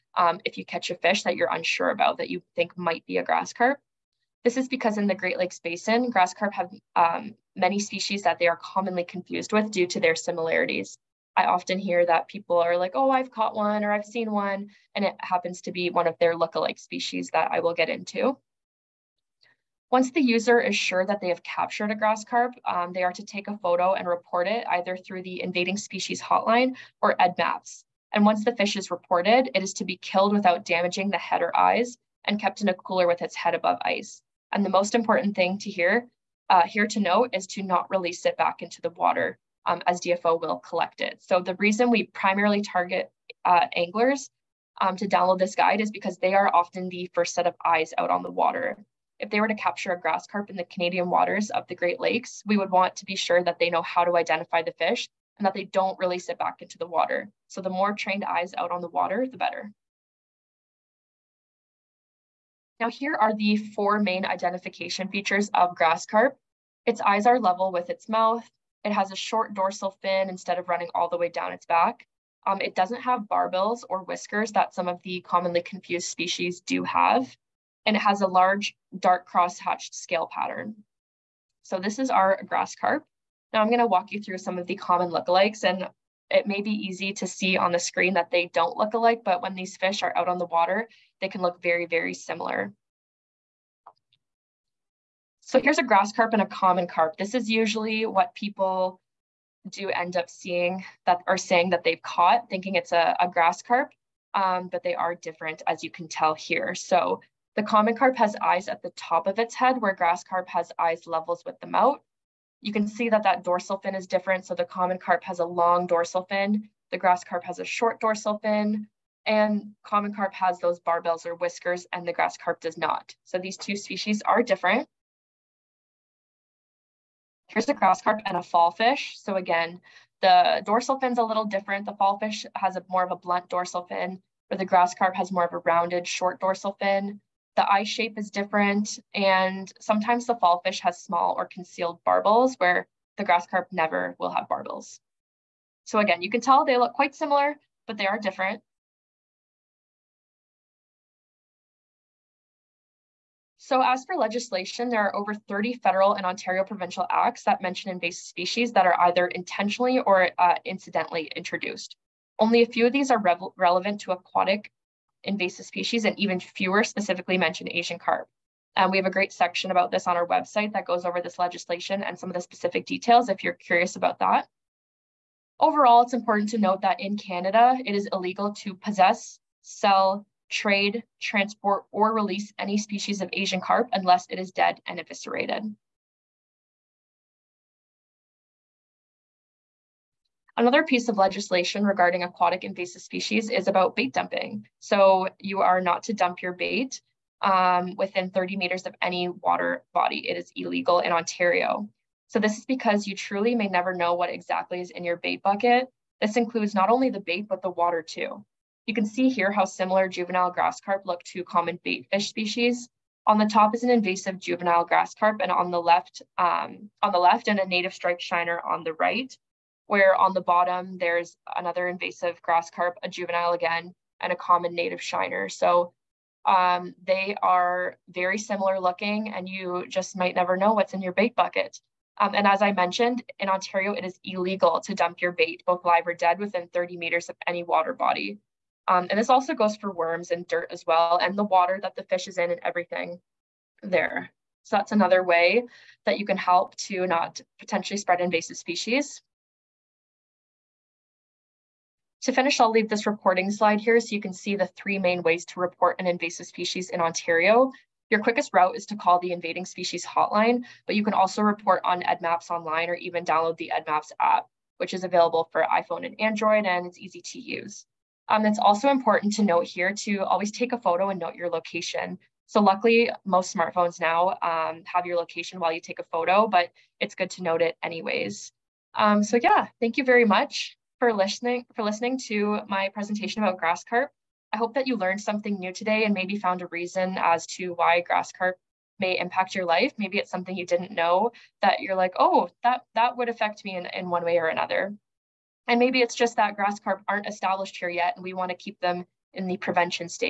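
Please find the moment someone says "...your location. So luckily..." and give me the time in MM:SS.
04:31.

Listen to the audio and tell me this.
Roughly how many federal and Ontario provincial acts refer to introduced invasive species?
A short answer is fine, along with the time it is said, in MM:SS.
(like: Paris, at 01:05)
over 30, at 02:35.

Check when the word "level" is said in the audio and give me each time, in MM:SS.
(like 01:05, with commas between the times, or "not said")
01:07, 01:51.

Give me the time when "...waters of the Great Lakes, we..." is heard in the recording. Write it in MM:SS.
00:51.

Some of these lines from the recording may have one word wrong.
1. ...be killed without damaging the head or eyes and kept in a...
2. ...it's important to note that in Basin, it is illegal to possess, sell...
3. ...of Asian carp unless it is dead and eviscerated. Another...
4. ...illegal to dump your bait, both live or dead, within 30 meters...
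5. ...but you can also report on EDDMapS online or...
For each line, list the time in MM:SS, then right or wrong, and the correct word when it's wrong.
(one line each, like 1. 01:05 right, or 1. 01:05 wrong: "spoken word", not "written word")
1. 00:29 right
2. 02:56 wrong: "Canada", not "Basin"
3. 03:03 right
4. 03:54 right
5. 04:20 right.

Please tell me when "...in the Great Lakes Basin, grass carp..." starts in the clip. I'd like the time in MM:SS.
00:04.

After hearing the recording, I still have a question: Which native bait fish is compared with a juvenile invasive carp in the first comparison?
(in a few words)
striped shiner.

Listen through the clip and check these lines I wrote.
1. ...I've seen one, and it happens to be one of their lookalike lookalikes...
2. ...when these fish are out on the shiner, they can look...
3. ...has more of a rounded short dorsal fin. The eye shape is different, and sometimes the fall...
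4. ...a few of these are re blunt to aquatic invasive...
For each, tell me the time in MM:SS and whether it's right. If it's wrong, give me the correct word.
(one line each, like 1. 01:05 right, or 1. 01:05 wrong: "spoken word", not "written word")
1. 00:13 wrong: "species", not "lookalikes"
2. 01:29 wrong: "water", not "shiner"
3. 02:15 right
4. 02:42 wrong: "relevant", not "blunt".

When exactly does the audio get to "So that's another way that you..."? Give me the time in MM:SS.
04:04.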